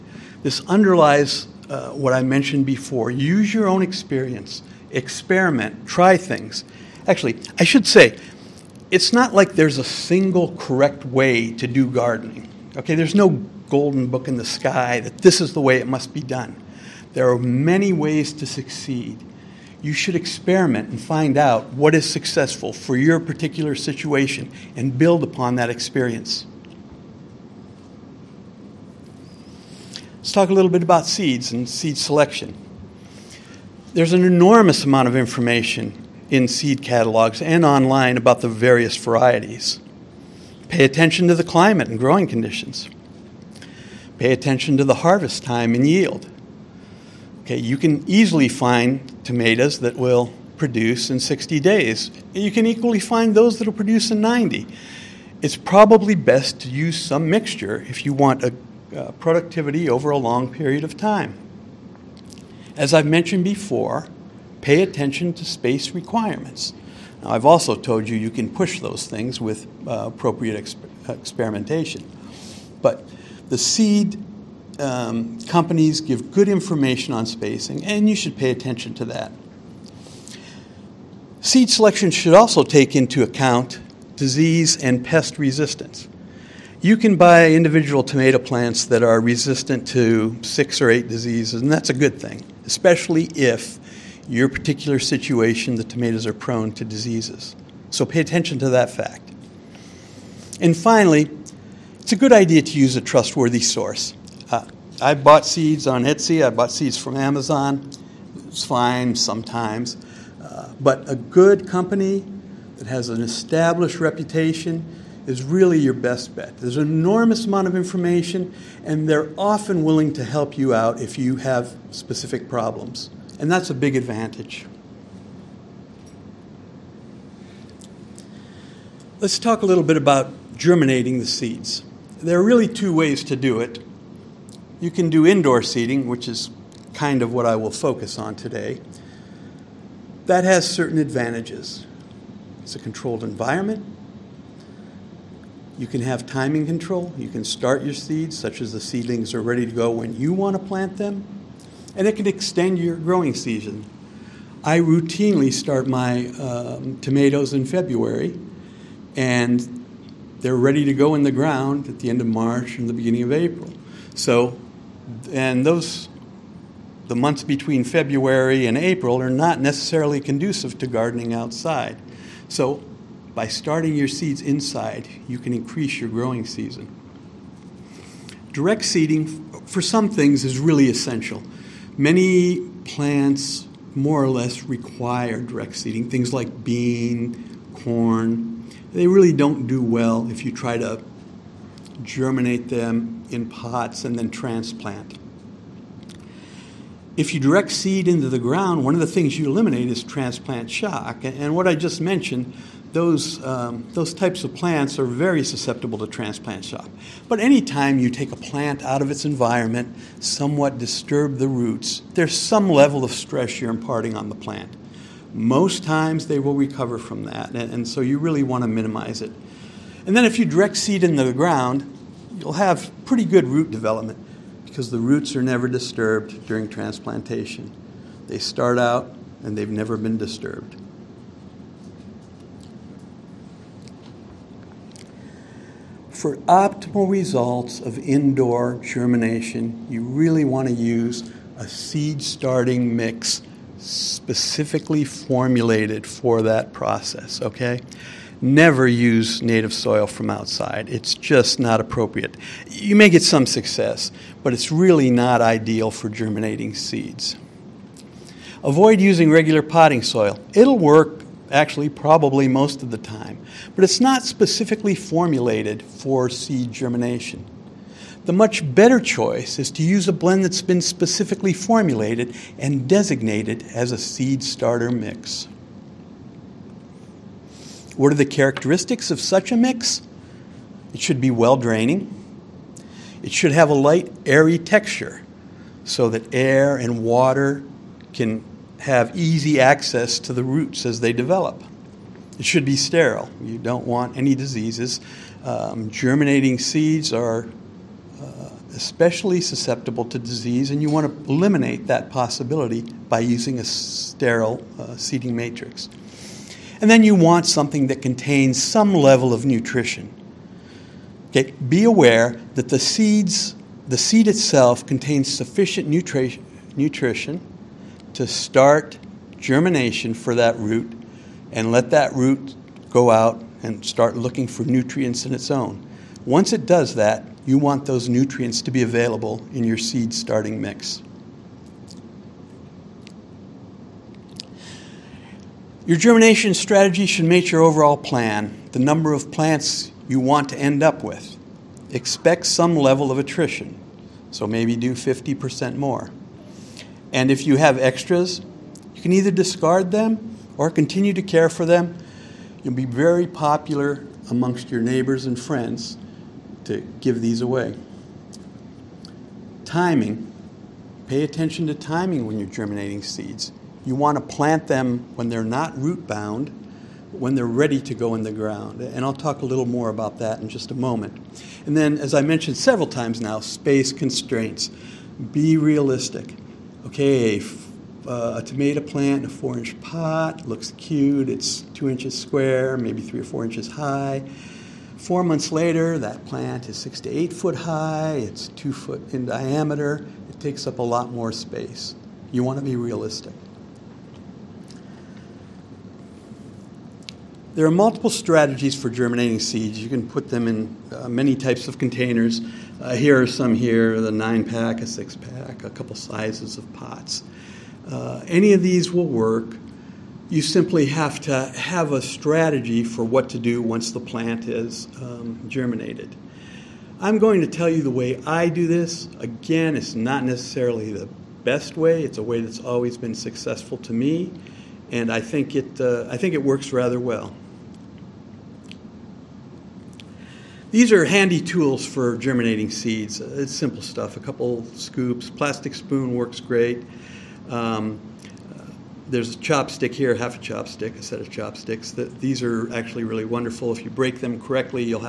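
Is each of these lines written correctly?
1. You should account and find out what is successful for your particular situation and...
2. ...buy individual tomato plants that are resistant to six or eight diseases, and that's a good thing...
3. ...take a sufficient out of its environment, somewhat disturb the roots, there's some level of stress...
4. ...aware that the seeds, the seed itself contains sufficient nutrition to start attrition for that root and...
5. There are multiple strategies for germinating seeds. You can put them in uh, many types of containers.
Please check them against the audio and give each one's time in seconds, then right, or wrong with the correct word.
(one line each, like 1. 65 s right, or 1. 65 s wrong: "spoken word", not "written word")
1. 19 s wrong: "experiment", not "account"
2. 87 s right
3. 208 s wrong: "plant", not "sufficient"
4. 311 s wrong: "germination", not "attrition"
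5. 397 s right.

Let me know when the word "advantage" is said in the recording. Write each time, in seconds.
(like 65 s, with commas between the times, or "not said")
123 s, 140 s.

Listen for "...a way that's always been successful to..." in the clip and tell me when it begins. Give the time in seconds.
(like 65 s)
422 s.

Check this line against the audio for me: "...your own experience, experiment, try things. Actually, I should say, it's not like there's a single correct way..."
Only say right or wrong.
right.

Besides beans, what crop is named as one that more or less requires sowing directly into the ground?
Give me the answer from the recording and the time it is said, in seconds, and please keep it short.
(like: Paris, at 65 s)
corn, at 187 s.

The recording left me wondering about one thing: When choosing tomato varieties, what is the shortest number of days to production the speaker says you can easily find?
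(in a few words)
60 days.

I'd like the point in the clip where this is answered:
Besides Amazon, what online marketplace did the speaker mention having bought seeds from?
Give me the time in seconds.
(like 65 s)
106 s.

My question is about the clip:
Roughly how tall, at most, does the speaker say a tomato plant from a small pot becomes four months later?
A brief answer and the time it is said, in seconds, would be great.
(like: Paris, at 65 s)
8 feet, at 387 s.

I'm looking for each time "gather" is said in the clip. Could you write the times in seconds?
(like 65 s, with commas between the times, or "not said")
not said.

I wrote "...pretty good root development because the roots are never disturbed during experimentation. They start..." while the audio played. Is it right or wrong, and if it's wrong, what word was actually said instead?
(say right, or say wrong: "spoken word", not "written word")
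wrong: "transplantation", not "experimentation".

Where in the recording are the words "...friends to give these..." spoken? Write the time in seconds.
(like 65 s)
355 s.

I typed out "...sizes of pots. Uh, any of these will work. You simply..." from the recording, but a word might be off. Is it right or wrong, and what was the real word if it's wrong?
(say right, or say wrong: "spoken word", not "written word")
right.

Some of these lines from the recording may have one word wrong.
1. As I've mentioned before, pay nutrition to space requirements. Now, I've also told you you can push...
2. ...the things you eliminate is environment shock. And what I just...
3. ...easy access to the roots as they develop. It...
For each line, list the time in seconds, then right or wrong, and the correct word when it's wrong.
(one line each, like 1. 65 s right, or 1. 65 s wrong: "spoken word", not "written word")
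1. 62 s wrong: "attention", not "nutrition"
2. 199 s wrong: "transplant", not "environment"
3. 289 s right.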